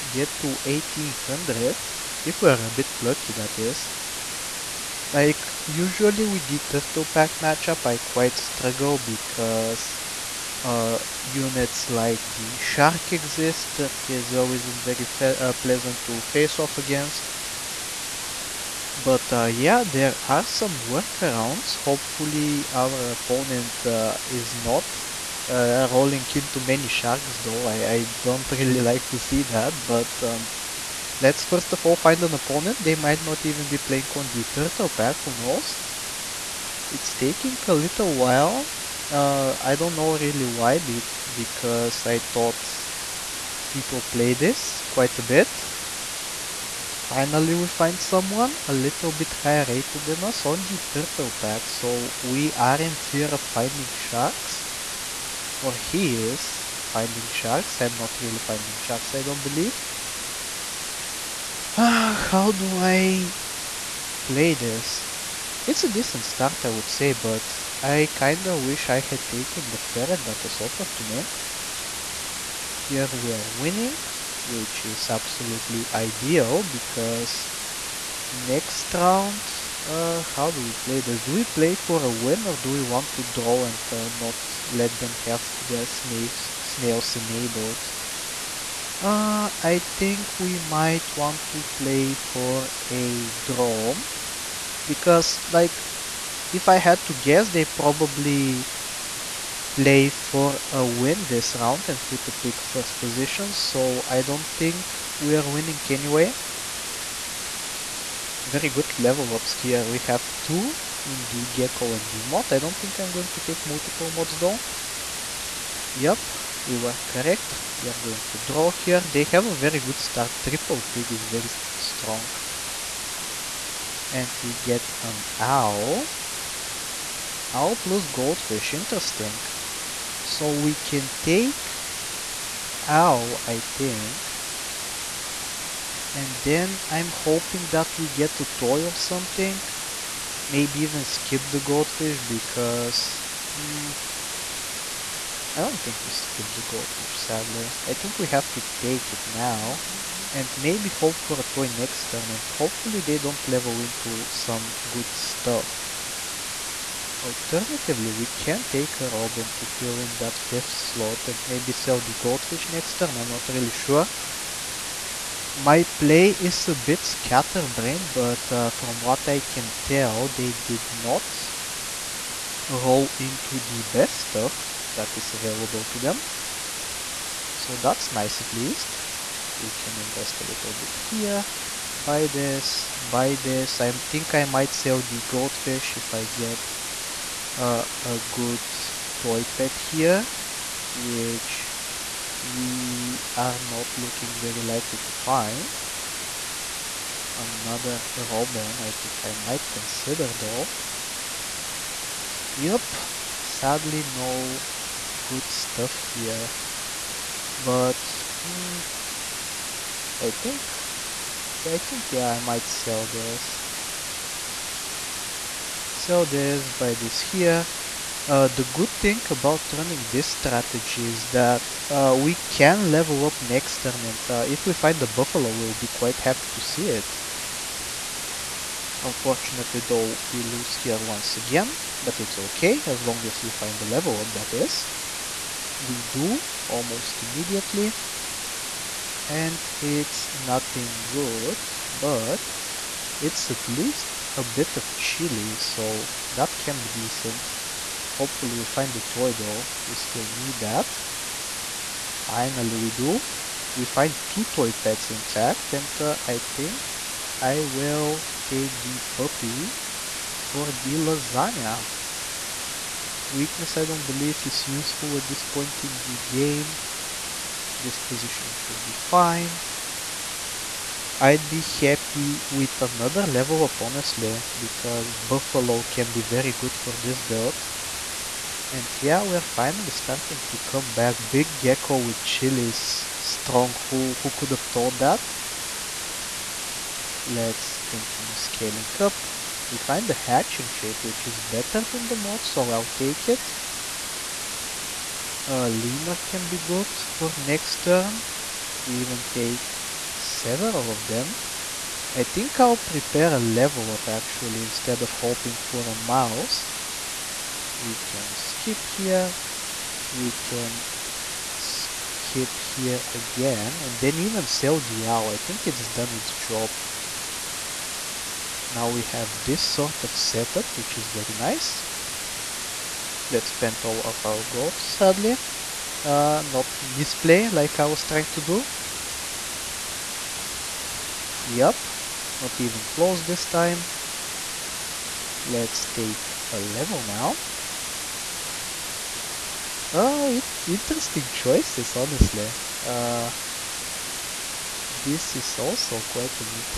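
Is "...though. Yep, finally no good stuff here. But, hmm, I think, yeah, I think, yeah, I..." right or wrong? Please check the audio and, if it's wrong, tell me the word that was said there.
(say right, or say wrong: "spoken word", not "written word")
wrong: "sadly", not "finally".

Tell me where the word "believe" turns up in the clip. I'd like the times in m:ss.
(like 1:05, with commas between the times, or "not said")
0:59, 4:24.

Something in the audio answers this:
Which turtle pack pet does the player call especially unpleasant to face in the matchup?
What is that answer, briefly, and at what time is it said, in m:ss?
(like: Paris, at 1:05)
Shark, at 0:12.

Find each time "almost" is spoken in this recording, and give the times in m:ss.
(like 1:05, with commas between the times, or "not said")
3:56.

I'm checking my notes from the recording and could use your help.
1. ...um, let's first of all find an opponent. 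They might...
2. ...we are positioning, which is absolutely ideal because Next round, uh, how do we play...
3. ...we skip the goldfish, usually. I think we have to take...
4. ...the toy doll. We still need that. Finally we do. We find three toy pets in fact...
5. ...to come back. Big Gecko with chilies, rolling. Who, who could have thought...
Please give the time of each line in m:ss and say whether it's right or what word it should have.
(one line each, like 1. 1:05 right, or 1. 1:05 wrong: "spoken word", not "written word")
1. 0:30 right
2. 1:13 wrong: "winning", not "positioning"
3. 2:26 wrong: "sadly", not "usually"
4. 4:08 wrong: "two", not "three"
5. 4:40 wrong: "strong", not "rolling".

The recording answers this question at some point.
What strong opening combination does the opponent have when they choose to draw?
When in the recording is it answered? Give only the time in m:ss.
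2:00.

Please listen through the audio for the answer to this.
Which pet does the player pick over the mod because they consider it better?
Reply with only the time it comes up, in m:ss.
4:50.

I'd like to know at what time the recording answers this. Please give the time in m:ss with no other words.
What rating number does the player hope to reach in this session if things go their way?
0:00.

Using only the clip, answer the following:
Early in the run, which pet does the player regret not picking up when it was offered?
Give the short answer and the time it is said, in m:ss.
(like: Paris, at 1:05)
Ferret, at 1:09.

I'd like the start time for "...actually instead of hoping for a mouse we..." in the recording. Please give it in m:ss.
5:04.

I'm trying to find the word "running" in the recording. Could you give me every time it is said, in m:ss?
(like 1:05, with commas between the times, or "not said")
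3:39.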